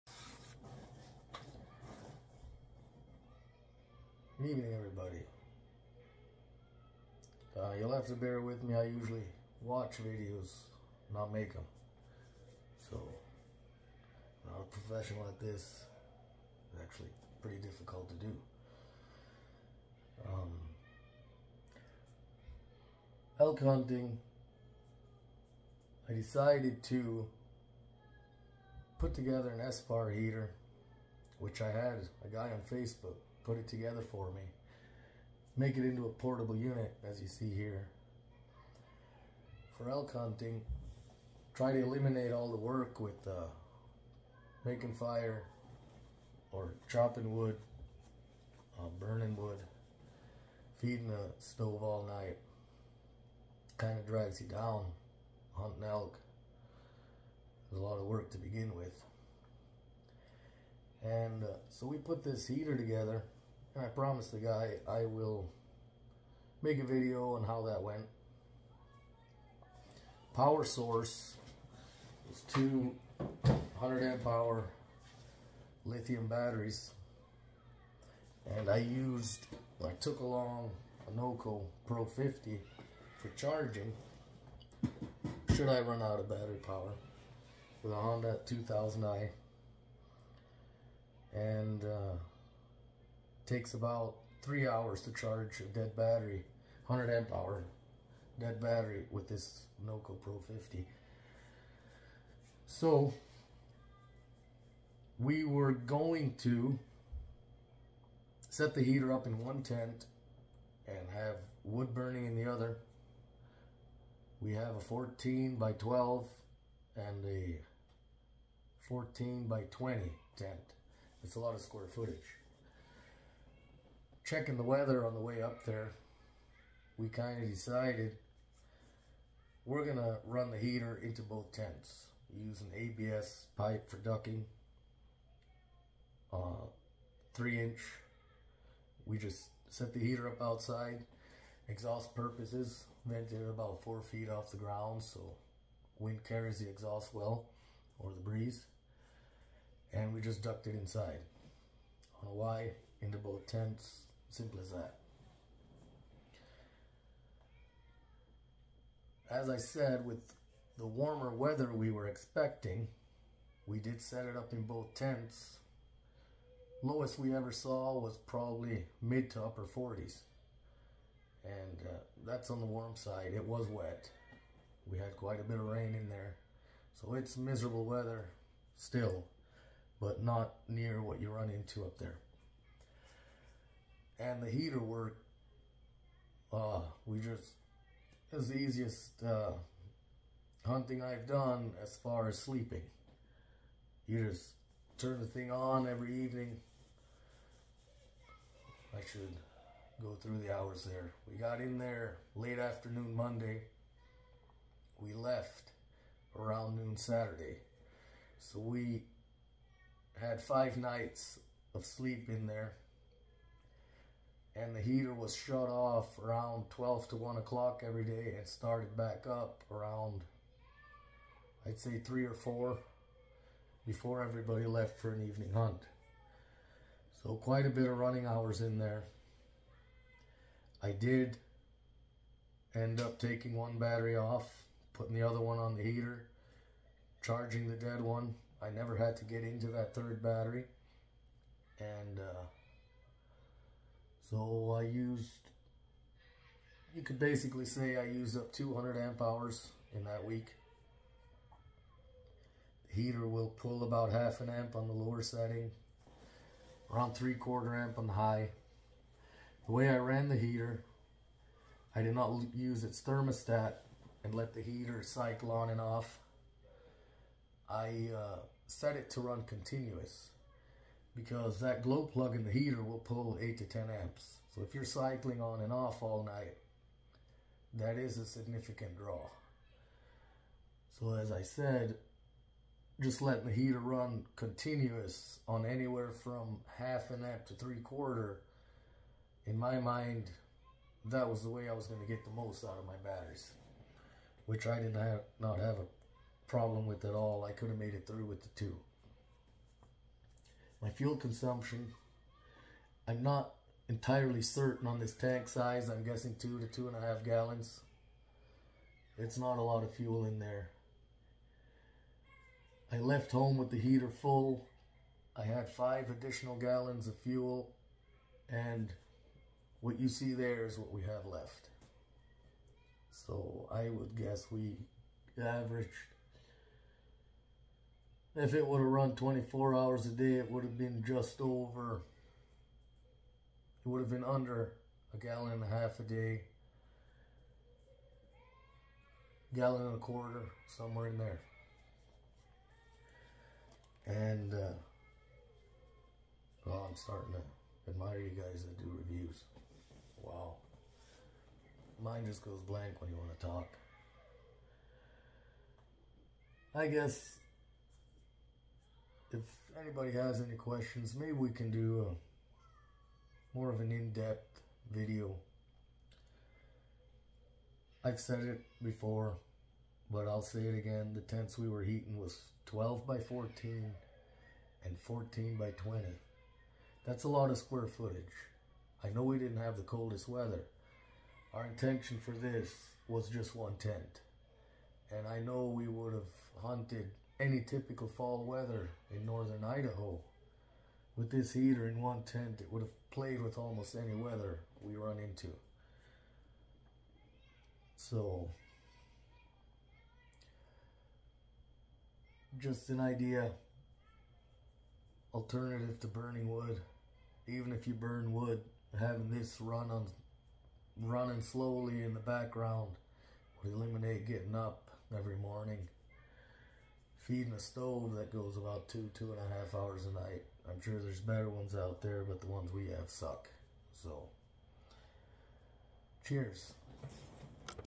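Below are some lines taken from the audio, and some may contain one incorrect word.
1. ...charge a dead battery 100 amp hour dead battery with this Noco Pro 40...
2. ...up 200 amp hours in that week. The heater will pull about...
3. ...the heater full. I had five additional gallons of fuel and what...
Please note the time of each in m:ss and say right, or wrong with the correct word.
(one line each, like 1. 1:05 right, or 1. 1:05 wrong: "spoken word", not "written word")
1. 1:35 wrong: "50", not "40"
2. 4:08 right
3. 5:13 right.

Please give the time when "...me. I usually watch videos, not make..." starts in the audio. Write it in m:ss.
0:08.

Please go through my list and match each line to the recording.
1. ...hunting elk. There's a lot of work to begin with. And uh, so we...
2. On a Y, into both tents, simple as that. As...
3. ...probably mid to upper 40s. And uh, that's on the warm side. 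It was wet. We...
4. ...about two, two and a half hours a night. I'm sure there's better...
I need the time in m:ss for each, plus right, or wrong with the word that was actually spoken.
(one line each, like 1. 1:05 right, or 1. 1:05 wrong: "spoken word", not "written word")
1. 0:55 right
2. 2:32 right
3. 2:48 right
4. 6:58 right.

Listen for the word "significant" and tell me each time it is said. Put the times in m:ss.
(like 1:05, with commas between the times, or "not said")
4:38.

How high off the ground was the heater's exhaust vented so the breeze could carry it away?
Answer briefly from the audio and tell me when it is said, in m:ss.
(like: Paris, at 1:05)
4 feet, at 2:23.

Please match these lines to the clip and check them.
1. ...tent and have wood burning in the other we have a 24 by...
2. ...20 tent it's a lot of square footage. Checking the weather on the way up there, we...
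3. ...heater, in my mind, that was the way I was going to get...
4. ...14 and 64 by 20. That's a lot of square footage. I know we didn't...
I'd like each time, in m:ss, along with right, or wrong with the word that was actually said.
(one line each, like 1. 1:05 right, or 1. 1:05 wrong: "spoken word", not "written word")
1. 1:49 wrong: "14", not "24"
2. 1:59 right
3. 4:47 wrong: "quarter", not "heater"
4. 6:13 wrong: "14", not "64".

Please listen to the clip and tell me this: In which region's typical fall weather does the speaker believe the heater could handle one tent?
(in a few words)
northern Idaho.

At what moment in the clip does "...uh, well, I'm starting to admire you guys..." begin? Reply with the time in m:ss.
5:44.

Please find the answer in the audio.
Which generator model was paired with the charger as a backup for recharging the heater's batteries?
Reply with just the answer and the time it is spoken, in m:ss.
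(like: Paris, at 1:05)
Honda 2000i, at 1:27.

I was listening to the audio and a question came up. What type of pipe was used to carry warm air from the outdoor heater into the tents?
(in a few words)
ABS pipe.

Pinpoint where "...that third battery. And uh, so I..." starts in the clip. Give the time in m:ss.
3:59.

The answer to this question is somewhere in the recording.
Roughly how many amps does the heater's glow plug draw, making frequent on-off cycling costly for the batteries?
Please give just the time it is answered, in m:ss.
4:33.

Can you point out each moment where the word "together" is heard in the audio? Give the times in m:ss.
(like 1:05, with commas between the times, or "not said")
0:29, 0:33, 1:02.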